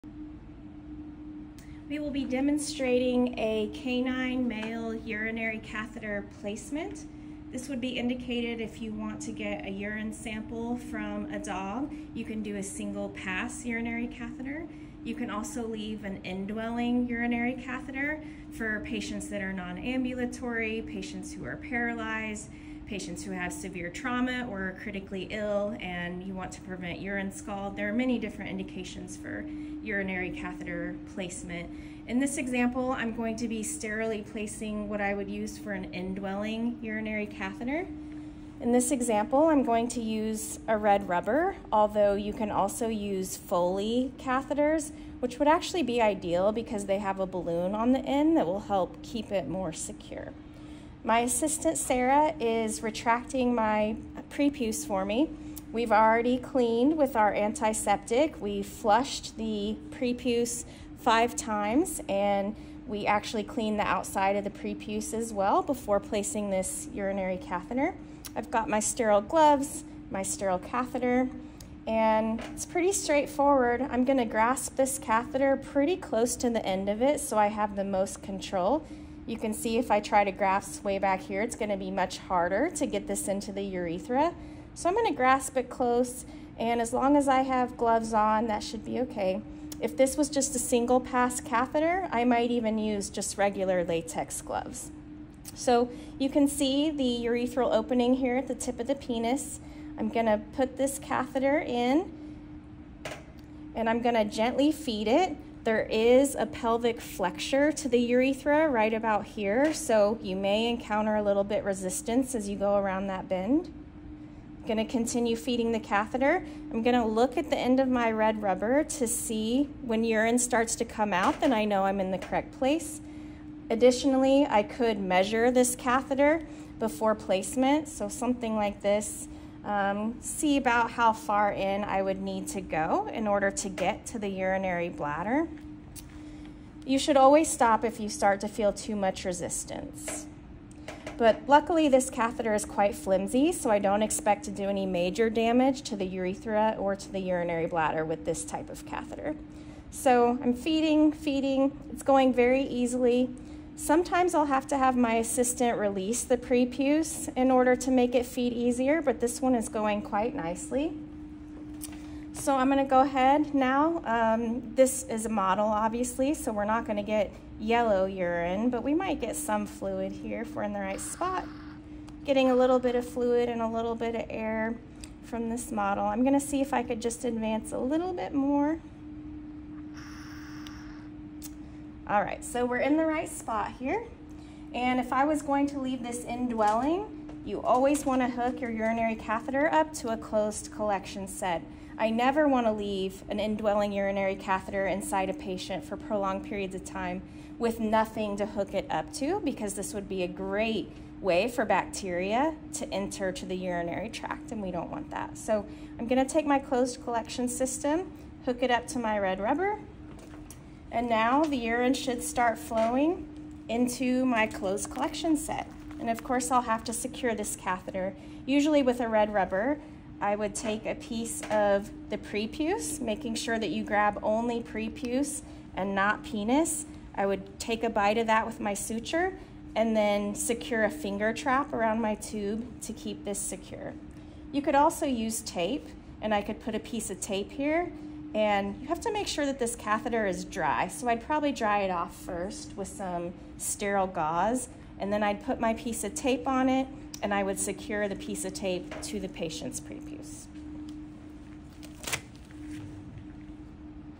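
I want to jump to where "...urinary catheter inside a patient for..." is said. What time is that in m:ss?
3:13.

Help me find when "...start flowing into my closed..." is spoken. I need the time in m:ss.
3:32.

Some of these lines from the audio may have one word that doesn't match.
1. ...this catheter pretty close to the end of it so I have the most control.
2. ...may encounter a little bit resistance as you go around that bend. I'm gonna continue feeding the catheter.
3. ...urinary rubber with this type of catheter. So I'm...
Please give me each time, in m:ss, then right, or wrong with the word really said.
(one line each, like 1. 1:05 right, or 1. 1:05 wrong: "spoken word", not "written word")
1. 1:14 right
2. 1:50 right
3. 2:27 wrong: "bladder", not "rubber".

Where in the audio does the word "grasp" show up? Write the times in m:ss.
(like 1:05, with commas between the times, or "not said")
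1:14, 1:20, 1:25.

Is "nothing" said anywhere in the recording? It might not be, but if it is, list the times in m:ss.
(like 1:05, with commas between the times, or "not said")
3:17.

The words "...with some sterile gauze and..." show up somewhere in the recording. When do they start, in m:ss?
4:02.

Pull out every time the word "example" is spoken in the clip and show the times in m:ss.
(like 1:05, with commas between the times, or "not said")
0:32, 0:38.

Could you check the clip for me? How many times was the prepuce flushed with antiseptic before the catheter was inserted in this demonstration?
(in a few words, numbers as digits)
5.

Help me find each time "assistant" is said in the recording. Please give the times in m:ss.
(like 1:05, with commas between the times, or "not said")
0:51, 2:35.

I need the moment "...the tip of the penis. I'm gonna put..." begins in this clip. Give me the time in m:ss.
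1:38.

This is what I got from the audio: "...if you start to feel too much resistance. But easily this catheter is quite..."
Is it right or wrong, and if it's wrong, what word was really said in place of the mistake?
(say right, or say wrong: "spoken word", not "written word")
wrong: "luckily", not "easily".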